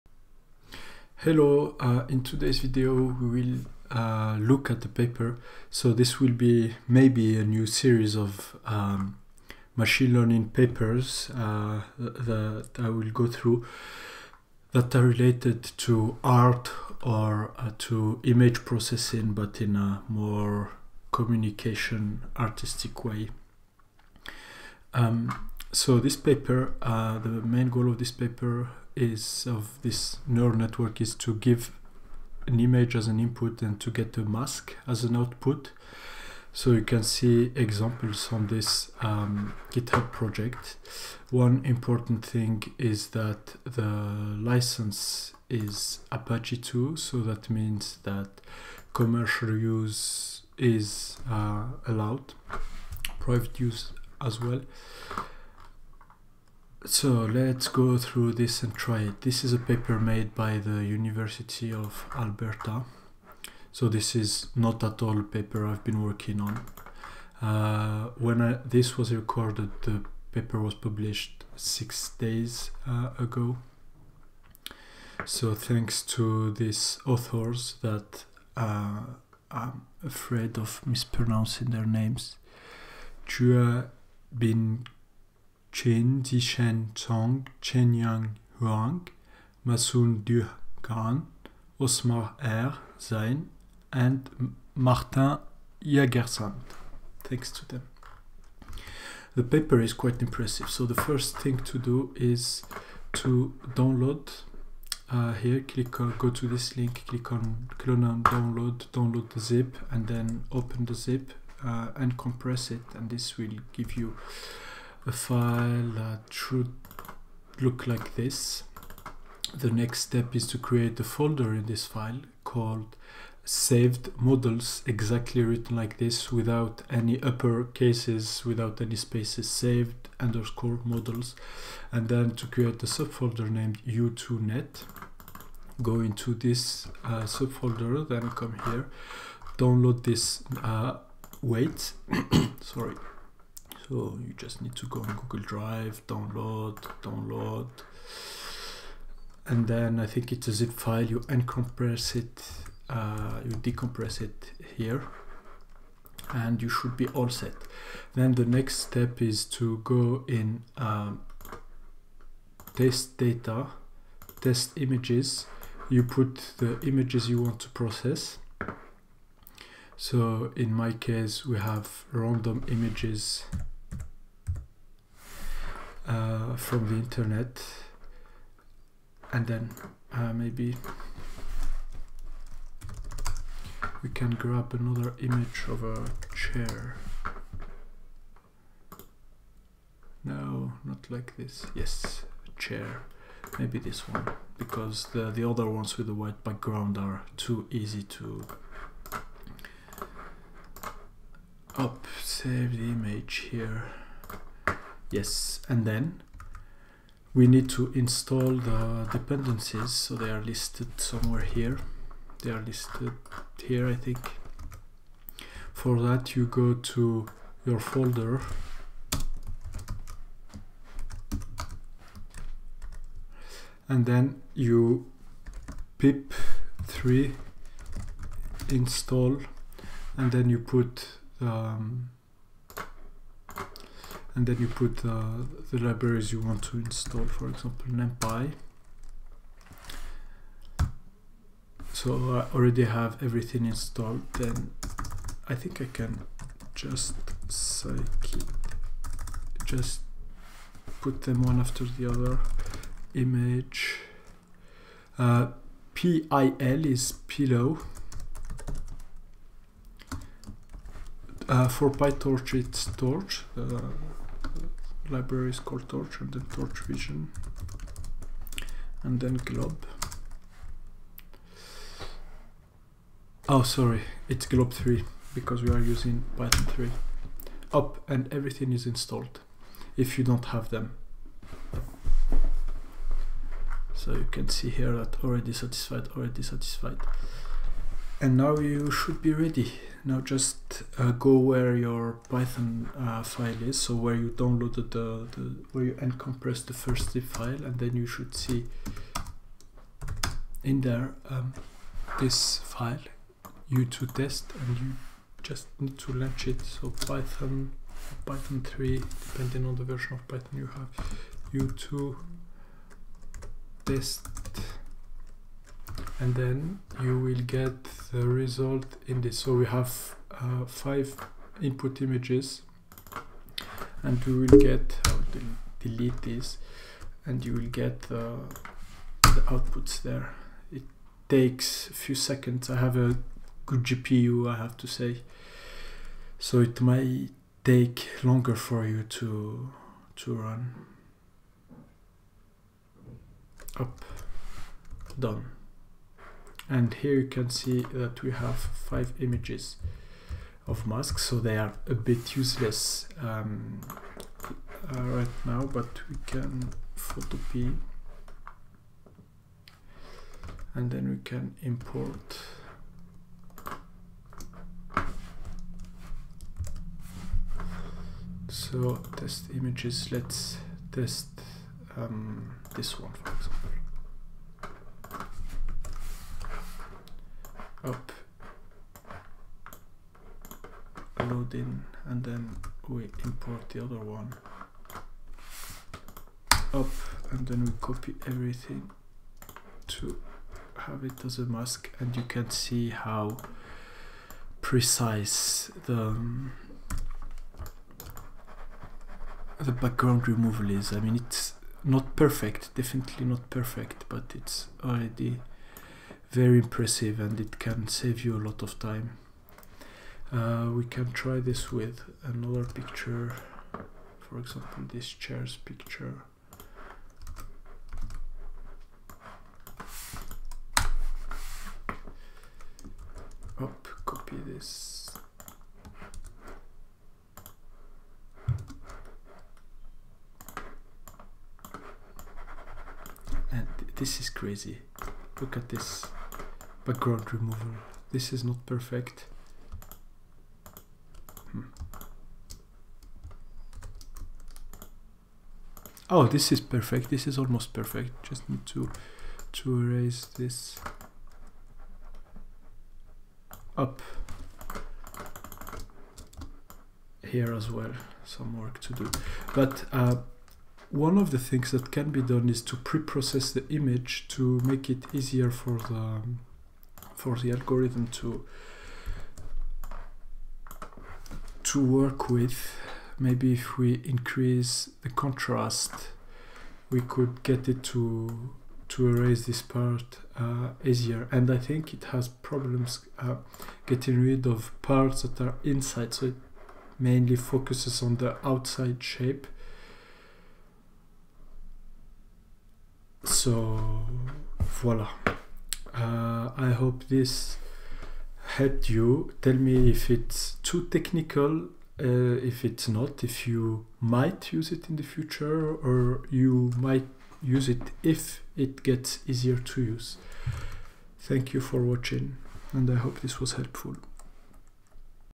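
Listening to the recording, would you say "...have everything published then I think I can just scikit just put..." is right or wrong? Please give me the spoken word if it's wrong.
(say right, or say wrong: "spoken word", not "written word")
wrong: "installed", not "published".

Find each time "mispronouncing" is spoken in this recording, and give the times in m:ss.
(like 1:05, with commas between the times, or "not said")
1:20.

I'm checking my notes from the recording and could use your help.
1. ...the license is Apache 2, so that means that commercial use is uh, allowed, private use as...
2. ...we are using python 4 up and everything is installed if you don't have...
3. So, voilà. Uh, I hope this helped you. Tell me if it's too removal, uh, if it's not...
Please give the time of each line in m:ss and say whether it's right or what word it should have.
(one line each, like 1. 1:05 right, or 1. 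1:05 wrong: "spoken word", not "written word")
1. 0:43 right
2. 4:35 wrong: "3", not "4"
3. 8:13 wrong: "technical", not "removal".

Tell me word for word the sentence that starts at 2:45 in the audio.
You put the images you want to process.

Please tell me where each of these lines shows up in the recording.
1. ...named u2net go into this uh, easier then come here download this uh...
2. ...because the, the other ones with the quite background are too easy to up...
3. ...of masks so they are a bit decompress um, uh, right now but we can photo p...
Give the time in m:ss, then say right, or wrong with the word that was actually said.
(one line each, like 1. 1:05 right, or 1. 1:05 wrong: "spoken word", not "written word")
1. 2:13 wrong: "subfolder", not "easier"
2. 3:14 wrong: "white", not "quite"
3. 5:50 wrong: "useless", not "decompress".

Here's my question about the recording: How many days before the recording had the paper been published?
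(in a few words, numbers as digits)
6.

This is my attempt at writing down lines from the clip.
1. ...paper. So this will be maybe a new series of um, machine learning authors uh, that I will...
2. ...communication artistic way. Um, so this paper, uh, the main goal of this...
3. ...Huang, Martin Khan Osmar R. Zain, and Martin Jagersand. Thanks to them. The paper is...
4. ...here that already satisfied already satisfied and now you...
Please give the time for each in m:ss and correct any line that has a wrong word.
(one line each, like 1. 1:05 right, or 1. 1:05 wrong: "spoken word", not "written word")
1. 0:04 wrong: "papers", not "authors"
2. 0:21 right
3. 1:28 wrong: "Masun", not "Martin"
4. 4:44 right.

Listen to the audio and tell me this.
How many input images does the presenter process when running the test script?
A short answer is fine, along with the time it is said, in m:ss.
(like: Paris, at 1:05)
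5, at 5:20.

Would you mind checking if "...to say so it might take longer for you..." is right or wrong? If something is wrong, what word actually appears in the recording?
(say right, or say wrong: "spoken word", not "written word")
right.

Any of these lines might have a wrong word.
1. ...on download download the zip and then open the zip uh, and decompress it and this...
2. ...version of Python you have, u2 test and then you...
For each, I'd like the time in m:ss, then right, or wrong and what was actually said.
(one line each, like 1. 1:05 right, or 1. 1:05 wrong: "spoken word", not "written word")
1. 1:48 wrong: "compress", not "decompress"
2. 5:09 right.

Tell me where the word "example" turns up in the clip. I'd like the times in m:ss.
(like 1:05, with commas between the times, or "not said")
0:37, 3:57, 6:13, 6:54.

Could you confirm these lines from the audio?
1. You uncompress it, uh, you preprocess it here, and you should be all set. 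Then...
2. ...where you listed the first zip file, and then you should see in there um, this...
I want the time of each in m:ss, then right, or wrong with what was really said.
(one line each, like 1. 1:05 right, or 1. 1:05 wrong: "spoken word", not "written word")
1. 2:31 wrong: "decompress", not "preprocess"
2. 4:55 wrong: "uncompressed", not "listed".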